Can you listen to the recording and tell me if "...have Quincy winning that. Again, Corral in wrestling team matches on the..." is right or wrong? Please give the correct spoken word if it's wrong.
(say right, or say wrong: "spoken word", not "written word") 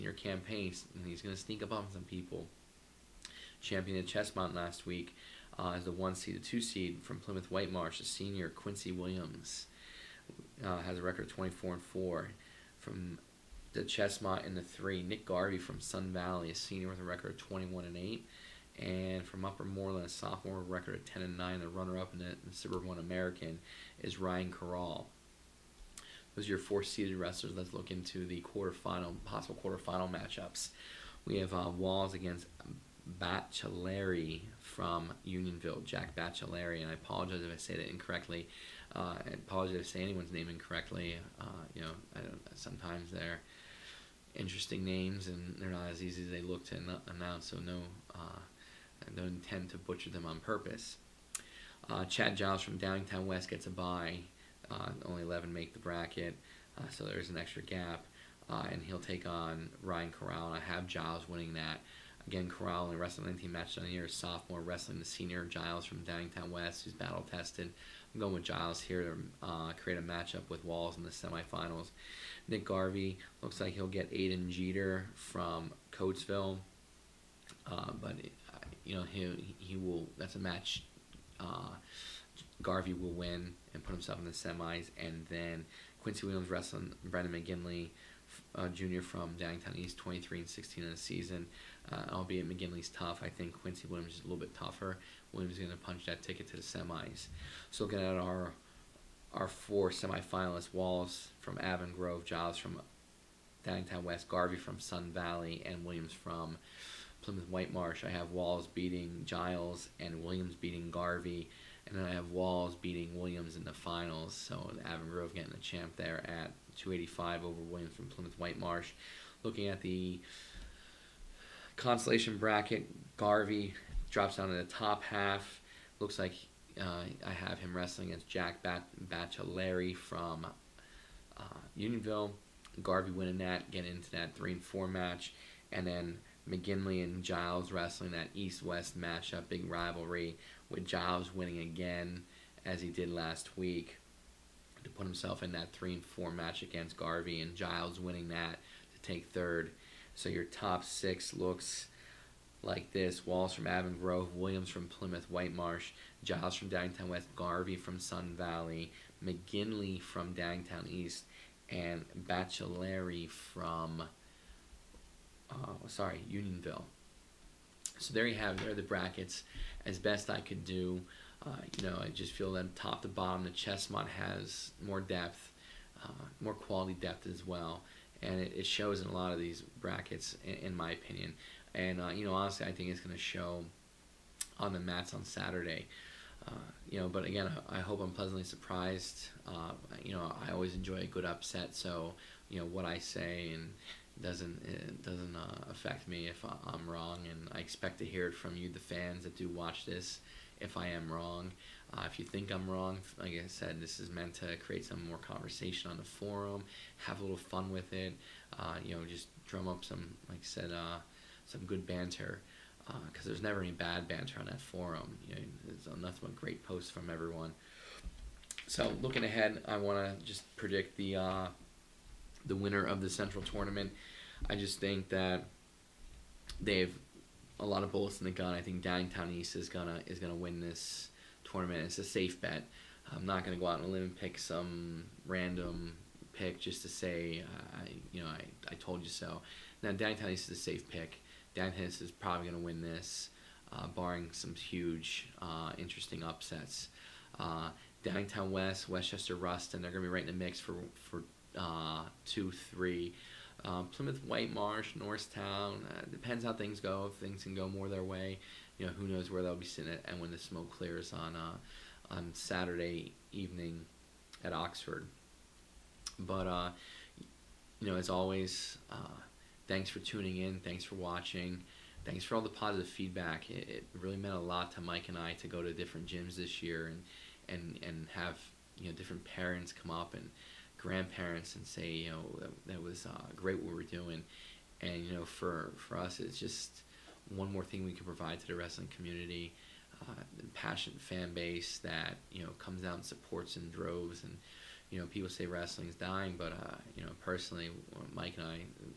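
wrong: "Giles", not "Quincy".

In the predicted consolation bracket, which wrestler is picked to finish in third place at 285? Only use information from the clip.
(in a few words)
Chad Giles.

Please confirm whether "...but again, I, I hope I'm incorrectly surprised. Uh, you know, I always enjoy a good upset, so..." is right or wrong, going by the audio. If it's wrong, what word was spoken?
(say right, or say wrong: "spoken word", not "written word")
wrong: "pleasantly", not "incorrectly".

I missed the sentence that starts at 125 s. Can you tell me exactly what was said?
Looks like uh, I have him wrestling against Jack Bat- Bachelary from uh, Unionville.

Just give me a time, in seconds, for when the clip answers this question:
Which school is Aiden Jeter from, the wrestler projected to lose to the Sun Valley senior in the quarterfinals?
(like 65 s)
75 s.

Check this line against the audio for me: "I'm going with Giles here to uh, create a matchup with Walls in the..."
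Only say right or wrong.
right.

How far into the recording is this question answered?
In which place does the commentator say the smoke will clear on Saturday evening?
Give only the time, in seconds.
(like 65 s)
264 s.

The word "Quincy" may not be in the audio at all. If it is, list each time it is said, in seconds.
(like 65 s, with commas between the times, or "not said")
8 s, 86 s, 93 s.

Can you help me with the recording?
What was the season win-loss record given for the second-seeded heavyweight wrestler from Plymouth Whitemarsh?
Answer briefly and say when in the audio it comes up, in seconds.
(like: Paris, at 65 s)
24-4, at 11 s.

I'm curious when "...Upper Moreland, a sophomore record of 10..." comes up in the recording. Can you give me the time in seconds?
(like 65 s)
19 s.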